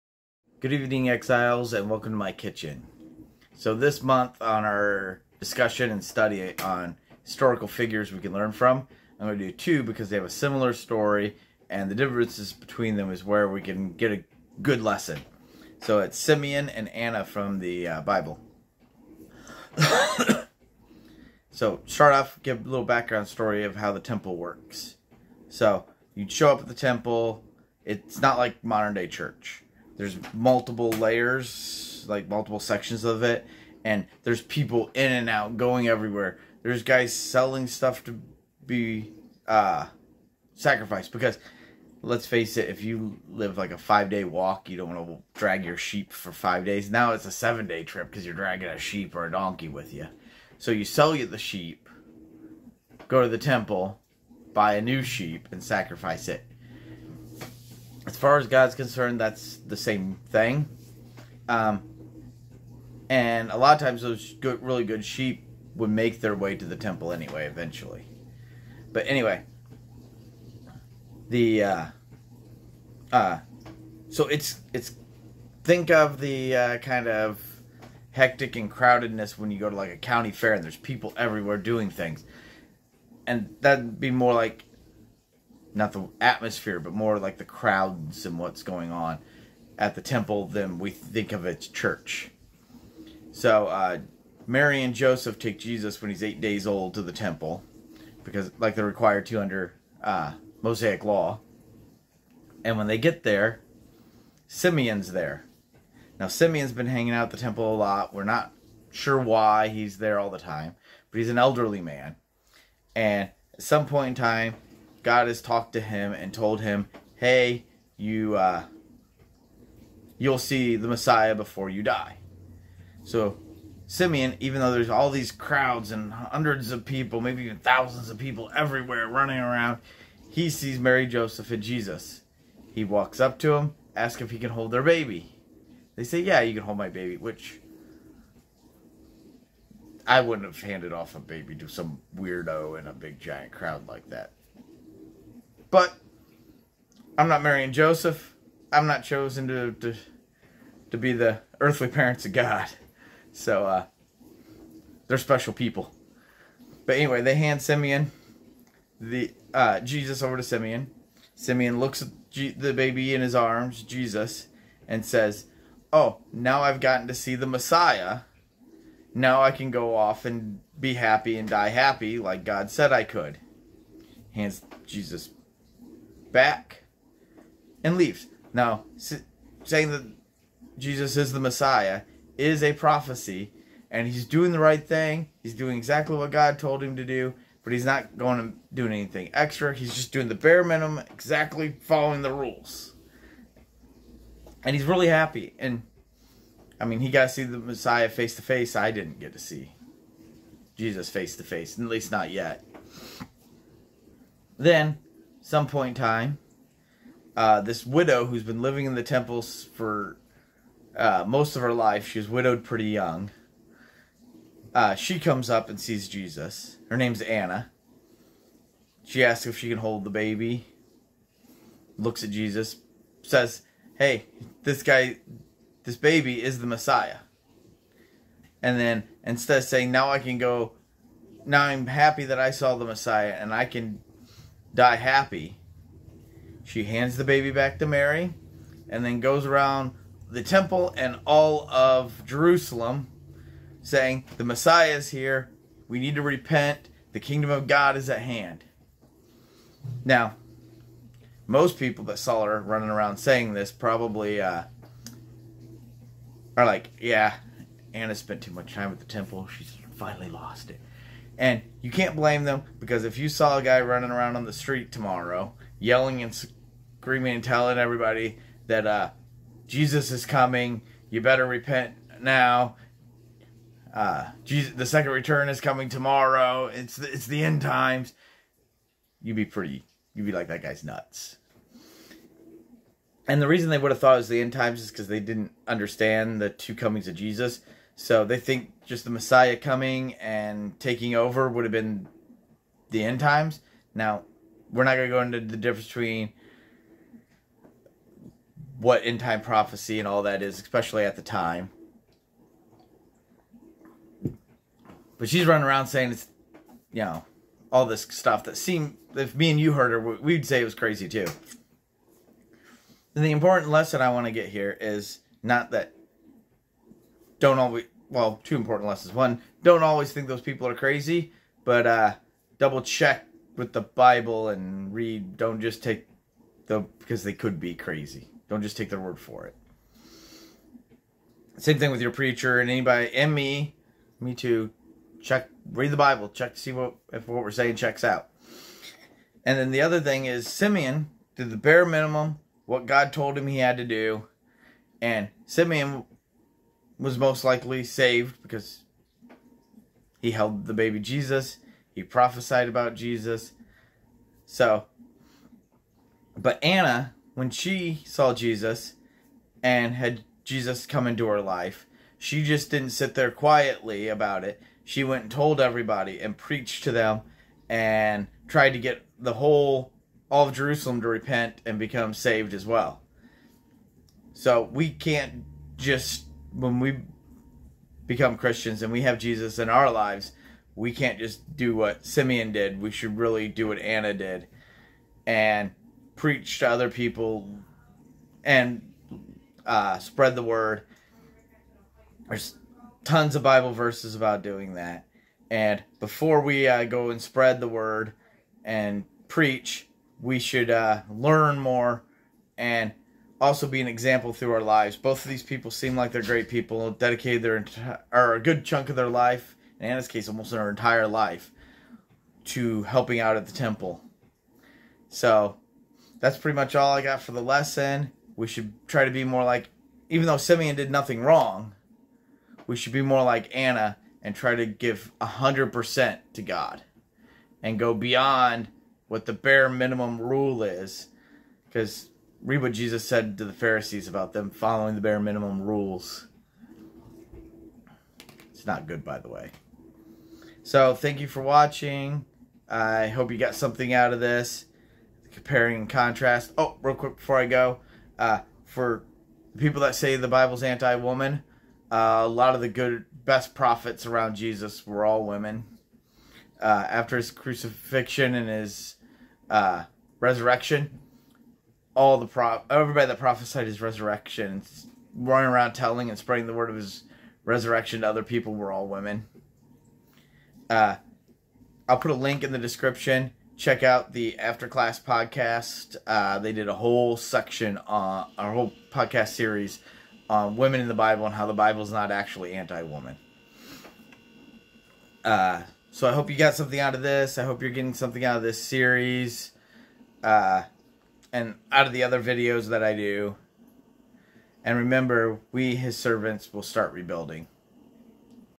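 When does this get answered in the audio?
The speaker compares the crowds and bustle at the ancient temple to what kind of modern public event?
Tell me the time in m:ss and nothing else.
1:19.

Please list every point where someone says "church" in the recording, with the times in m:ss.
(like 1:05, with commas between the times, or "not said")
0:29, 1:31.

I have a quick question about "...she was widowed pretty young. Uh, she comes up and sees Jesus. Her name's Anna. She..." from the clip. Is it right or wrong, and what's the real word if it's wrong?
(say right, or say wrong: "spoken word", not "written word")
right.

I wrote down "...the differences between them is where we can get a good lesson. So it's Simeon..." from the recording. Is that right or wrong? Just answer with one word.
right.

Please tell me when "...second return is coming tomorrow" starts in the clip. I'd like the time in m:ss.
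4:34.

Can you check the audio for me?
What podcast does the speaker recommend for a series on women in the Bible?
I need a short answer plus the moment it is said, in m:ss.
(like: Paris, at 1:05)
After Class podcast, at 7:54.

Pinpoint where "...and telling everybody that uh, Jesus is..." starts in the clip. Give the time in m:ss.
4:27.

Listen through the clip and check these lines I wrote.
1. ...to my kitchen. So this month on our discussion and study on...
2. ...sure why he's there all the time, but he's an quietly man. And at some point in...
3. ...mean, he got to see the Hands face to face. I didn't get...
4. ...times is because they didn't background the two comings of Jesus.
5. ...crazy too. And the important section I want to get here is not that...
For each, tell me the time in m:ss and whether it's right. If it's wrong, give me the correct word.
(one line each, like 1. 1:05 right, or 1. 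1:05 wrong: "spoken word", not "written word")
1. 0:02 right
2. 1:48 wrong: "elderly", not "quietly"
3. 3:16 wrong: "Messiah", not "Hands"
4. 4:44 wrong: "understand", not "background"
5. 5:10 wrong: "lesson", not "section".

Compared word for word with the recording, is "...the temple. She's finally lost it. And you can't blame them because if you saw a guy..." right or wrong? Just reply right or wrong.
right.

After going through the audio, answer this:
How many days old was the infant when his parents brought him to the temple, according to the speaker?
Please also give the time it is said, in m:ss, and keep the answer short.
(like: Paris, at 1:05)
8, at 1:36.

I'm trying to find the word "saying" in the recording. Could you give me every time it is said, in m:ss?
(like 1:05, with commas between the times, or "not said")
2:58, 3:49, 4:03, 4:13, 5:05, 5:37.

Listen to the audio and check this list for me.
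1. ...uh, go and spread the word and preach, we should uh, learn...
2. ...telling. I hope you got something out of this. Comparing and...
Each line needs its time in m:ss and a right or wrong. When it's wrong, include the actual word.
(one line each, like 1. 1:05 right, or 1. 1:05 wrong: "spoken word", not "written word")
1. 6:36 right
2. 7:21 wrong: "watching", not "telling".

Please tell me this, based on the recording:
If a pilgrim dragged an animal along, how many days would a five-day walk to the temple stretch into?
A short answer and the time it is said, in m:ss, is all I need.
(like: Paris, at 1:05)
7, at 0:47.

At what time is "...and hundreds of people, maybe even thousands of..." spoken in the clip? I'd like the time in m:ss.
2:05.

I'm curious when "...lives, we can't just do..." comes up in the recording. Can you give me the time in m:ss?
6:19.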